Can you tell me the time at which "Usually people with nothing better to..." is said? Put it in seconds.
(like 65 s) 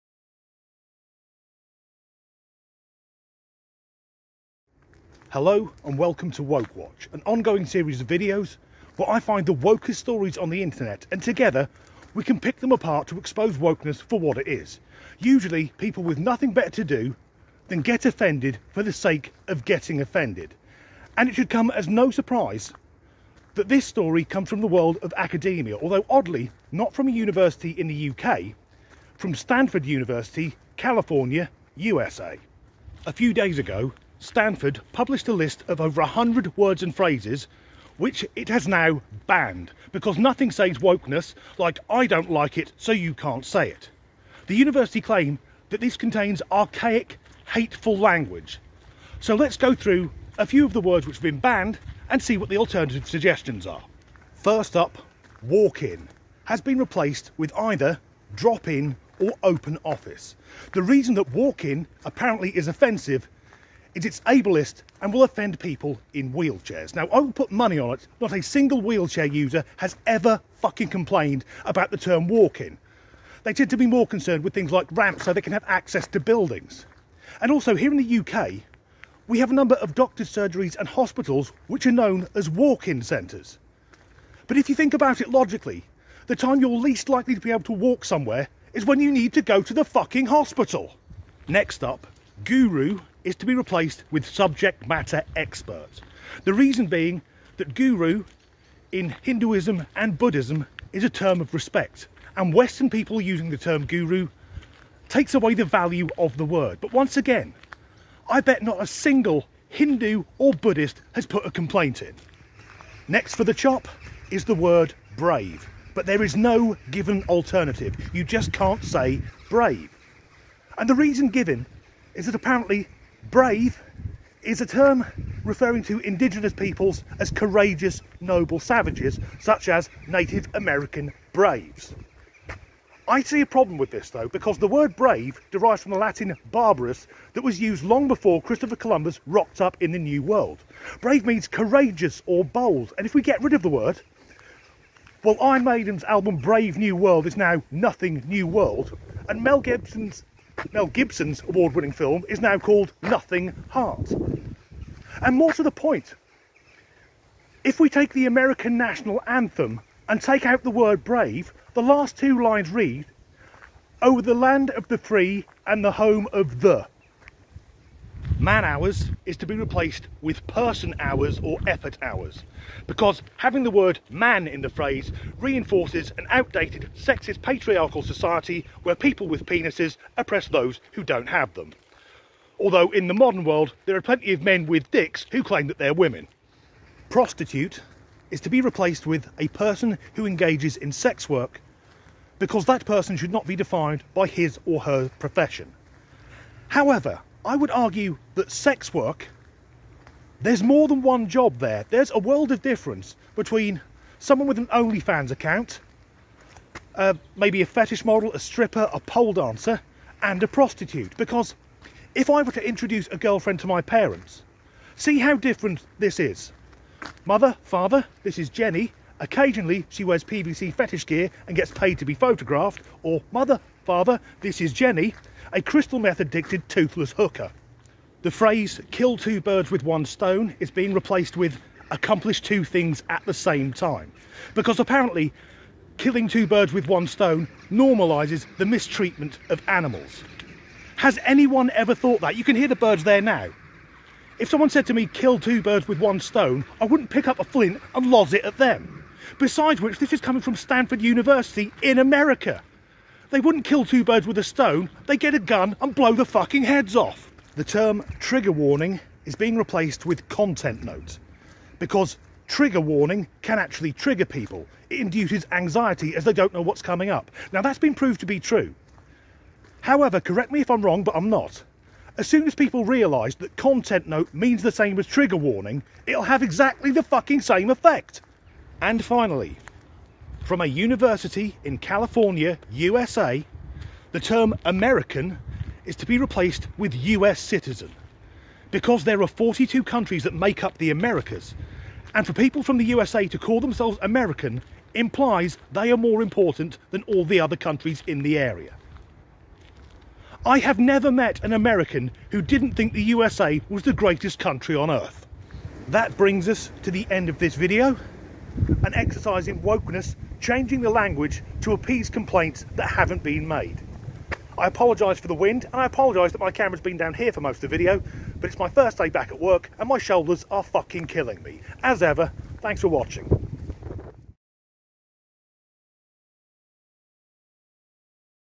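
15 s.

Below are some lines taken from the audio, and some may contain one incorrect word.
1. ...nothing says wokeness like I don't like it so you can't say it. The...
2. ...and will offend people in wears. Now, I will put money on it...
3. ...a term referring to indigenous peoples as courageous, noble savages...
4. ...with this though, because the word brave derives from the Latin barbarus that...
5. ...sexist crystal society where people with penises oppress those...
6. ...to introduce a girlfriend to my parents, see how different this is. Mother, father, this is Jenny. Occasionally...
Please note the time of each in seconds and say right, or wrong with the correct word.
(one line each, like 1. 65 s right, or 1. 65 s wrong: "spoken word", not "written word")
1. 40 s right
2. 65 s wrong: "wheelchairs", not "wears"
3. 124 s right
4. 133 s right
5. 176 s wrong: "patriarchal", not "crystal"
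6. 212 s right.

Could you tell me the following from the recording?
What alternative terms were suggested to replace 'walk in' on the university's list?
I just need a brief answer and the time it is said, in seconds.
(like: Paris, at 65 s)
drop in or open office, at 58 s.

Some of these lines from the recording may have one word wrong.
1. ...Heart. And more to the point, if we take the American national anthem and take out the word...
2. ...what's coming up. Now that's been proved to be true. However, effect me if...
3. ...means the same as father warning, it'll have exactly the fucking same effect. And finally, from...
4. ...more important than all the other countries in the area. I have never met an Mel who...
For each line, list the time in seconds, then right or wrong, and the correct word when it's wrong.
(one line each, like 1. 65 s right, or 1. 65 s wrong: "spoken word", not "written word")
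1. 153 s right
2. 266 s wrong: "correct", not "effect"
3. 274 s wrong: "trigger", not "father"
4. 295 s wrong: "American", not "Mel".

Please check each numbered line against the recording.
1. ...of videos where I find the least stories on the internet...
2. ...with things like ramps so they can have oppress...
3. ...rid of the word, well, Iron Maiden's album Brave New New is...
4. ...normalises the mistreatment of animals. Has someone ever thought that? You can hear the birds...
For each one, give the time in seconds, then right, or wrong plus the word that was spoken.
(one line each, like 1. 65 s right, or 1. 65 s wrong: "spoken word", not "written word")
1. 8 s wrong: "wokest", not "least"
2. 74 s wrong: "access", not "oppress"
3. 143 s wrong: "World", not "New"
4. 237 s wrong: "anyone", not "someone".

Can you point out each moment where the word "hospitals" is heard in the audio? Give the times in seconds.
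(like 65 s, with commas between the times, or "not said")
80 s, 90 s.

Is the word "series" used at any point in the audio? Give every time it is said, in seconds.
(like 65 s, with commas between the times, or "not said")
7 s.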